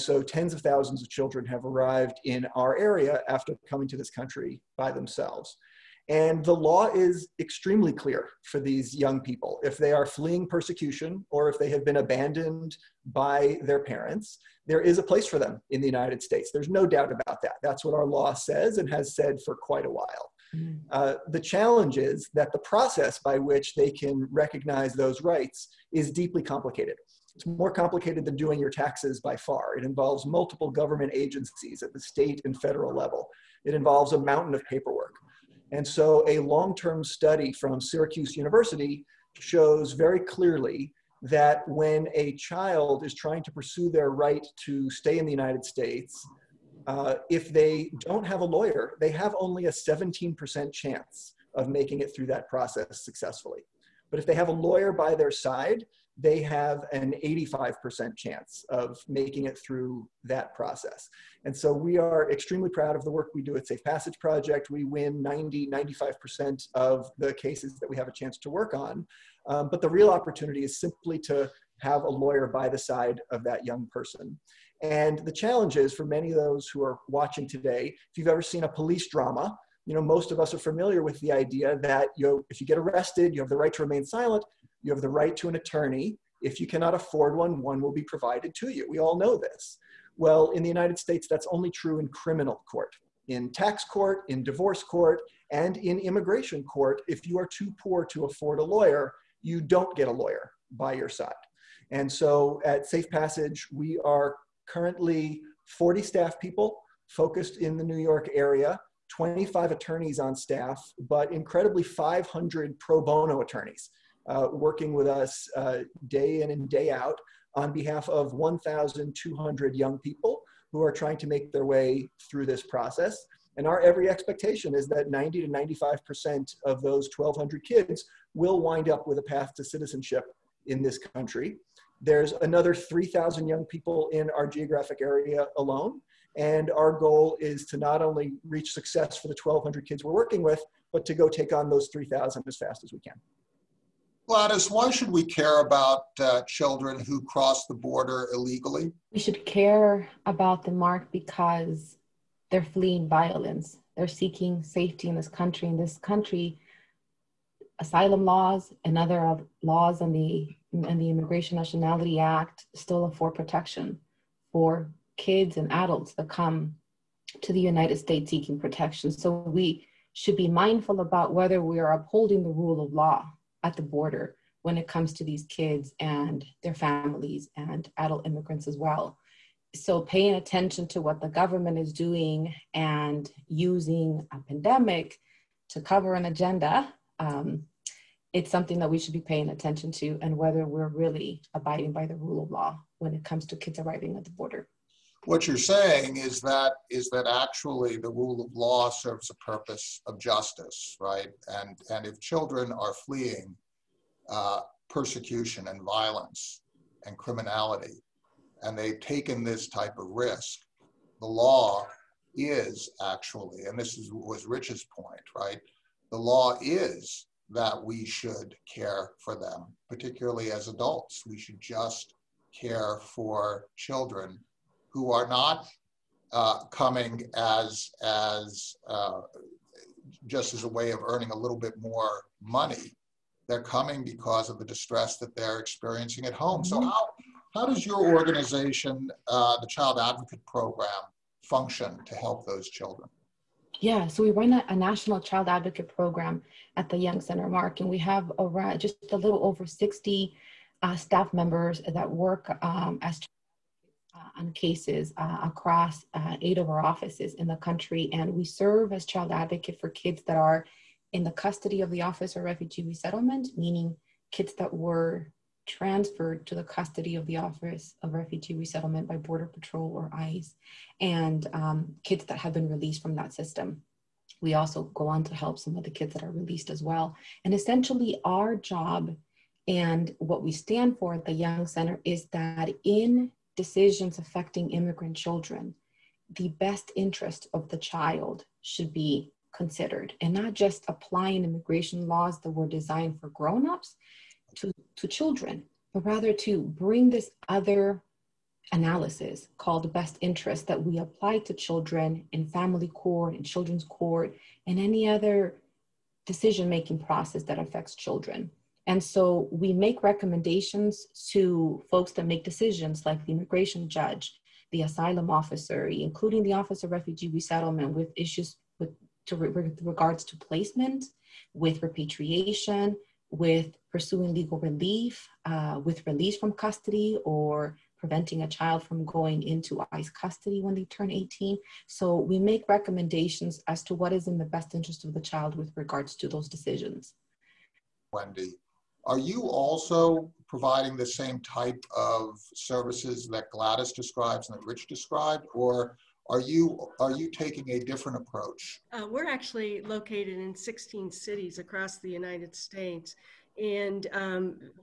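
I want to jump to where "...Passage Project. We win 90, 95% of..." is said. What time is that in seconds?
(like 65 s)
63 s.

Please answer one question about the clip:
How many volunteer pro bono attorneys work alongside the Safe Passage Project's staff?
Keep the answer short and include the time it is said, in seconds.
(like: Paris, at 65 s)
500, at 111 s.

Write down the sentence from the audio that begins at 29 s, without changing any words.
It involves multiple government agencies at the state and federal level.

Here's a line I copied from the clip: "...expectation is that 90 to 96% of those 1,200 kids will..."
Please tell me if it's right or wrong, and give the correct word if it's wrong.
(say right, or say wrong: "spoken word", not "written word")
wrong: "95", not "96".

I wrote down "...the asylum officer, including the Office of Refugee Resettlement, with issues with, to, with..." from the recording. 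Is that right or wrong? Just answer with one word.
right.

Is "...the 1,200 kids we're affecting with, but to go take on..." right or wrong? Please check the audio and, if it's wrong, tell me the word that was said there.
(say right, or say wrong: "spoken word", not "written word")
wrong: "working", not "affecting".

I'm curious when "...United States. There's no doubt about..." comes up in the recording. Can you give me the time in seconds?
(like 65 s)
15 s.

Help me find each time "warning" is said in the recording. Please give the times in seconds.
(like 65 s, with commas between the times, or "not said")
not said.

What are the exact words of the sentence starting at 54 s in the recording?
But if they have a lawyer by their side, they have an 85% chance of making it through that process.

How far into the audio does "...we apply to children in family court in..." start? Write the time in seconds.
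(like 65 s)
300 s.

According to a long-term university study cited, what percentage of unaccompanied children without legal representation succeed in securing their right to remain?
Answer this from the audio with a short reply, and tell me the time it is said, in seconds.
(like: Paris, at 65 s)
17%, at 49 s.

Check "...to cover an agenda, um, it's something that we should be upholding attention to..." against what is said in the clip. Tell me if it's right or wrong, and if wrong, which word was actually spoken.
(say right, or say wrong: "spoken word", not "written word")
wrong: "paying", not "upholding".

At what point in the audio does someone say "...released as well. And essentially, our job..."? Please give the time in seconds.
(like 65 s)
276 s.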